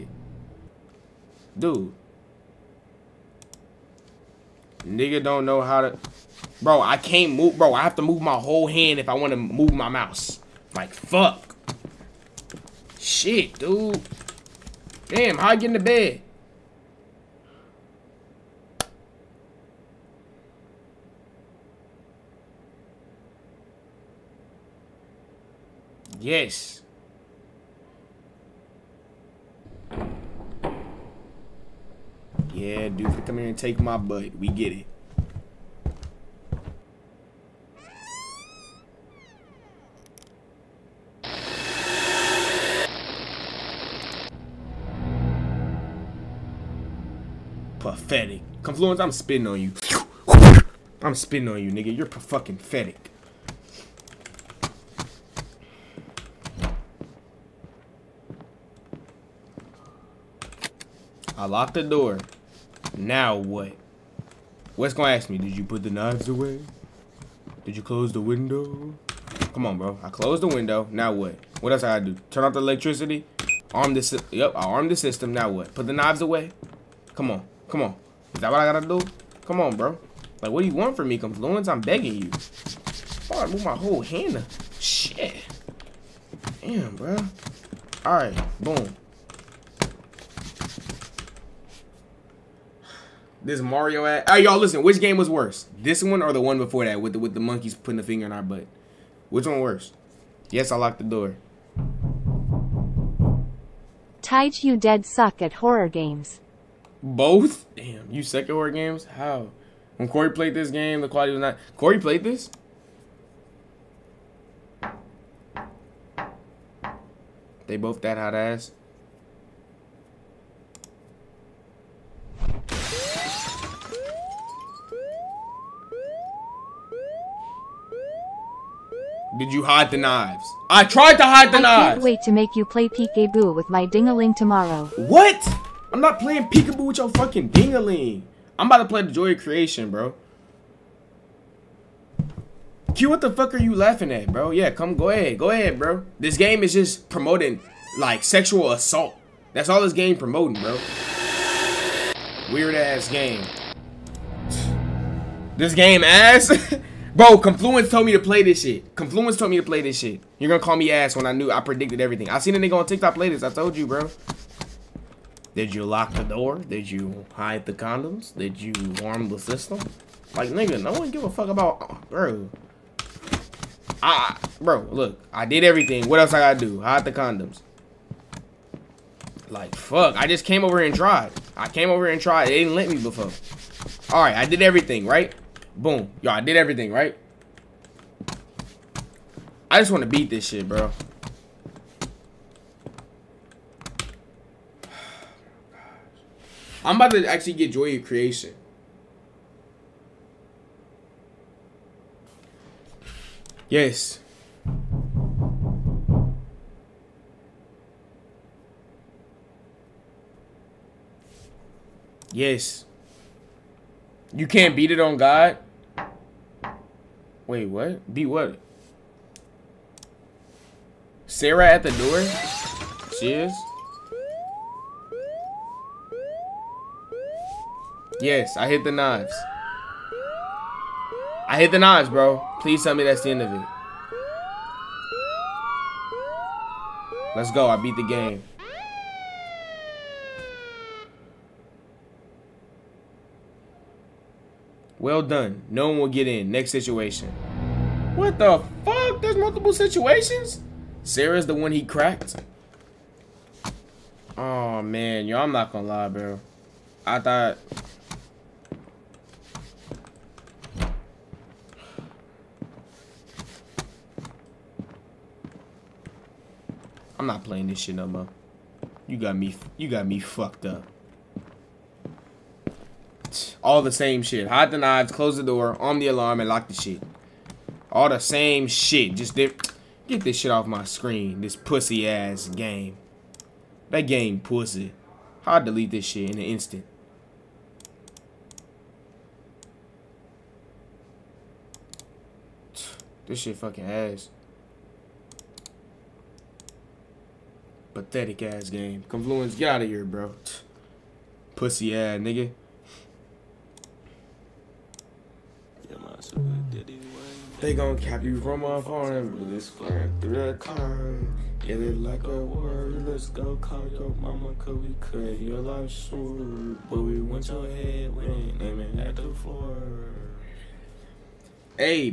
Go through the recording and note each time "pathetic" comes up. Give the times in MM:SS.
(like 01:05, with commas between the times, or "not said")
00:47, 00:52, 04:57.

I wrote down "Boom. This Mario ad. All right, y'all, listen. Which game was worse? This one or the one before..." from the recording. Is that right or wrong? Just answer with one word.
right.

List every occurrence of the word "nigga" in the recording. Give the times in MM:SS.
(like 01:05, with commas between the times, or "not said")
00:04, 00:51, 02:42, 02:50, 05:02.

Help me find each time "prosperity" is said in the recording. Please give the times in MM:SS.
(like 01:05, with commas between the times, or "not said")
not said.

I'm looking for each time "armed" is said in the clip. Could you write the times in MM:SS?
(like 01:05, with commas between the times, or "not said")
01:14.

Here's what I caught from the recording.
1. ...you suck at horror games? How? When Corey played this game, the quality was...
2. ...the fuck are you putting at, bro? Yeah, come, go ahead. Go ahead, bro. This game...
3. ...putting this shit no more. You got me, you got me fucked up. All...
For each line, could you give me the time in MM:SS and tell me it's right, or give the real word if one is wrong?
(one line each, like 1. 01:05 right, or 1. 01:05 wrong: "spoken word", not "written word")
1. 01:48 right
2. 02:23 wrong: "laughing", not "putting"
3. 04:27 wrong: "playing", not "putting".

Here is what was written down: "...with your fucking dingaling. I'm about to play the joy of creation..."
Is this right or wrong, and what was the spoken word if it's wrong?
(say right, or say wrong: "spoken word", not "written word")
right.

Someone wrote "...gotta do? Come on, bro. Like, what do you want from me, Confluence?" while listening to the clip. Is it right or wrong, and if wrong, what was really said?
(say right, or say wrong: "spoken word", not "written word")
right.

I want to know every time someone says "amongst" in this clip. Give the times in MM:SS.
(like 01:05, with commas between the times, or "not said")
not said.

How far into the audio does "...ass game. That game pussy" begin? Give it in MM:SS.
04:42.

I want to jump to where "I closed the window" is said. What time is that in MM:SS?
01:10.